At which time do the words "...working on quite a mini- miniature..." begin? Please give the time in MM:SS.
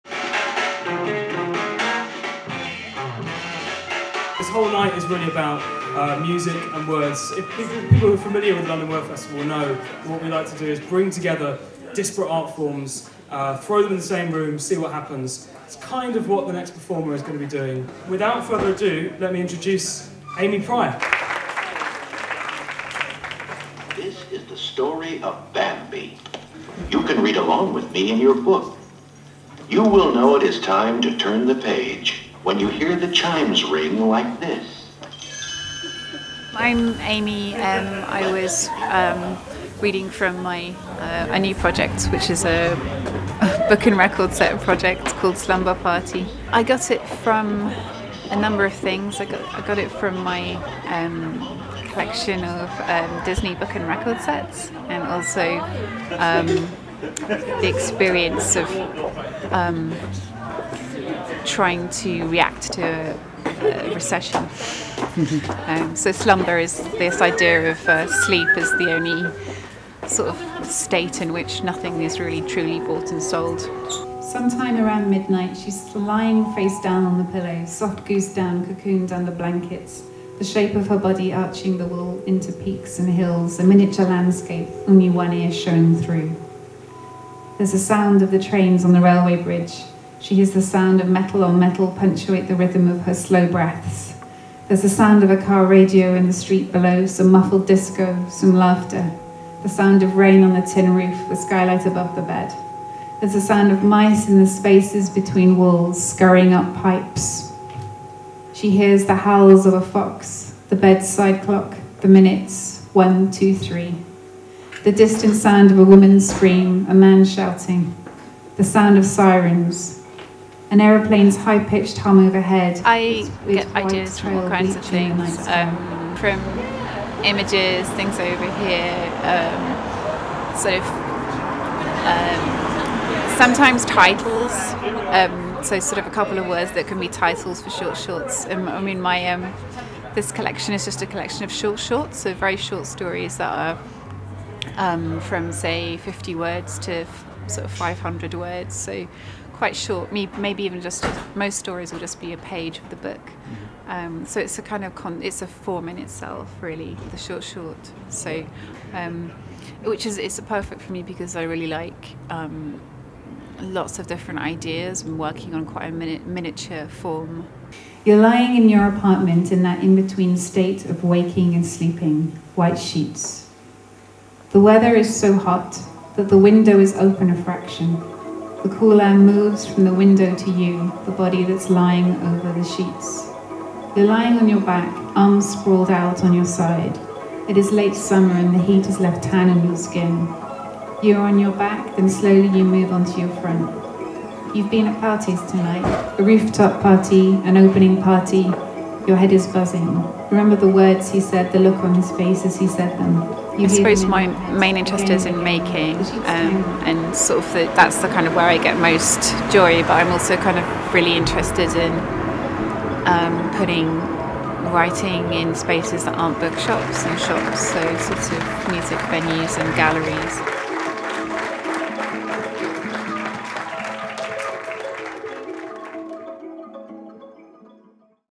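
02:45.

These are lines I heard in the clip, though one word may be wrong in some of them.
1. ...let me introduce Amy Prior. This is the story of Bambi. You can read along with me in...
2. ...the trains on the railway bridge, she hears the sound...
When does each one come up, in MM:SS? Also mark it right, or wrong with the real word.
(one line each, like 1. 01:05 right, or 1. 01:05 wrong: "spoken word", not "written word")
1. 00:19 right
2. 01:28 right.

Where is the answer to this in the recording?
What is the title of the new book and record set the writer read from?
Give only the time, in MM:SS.
00:45.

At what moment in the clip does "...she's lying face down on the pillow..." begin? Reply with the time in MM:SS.
01:15.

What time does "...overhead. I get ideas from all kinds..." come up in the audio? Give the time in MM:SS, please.
02:02.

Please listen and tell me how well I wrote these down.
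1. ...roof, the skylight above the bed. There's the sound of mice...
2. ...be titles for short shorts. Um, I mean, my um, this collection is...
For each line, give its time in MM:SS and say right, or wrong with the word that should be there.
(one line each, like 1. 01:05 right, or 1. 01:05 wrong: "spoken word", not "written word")
1. 01:40 right
2. 02:17 right.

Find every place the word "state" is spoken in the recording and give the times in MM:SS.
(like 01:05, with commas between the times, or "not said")
01:10, 02:50.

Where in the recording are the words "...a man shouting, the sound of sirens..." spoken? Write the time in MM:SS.
01:56.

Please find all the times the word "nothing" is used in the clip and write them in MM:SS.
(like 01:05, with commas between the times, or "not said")
01:11.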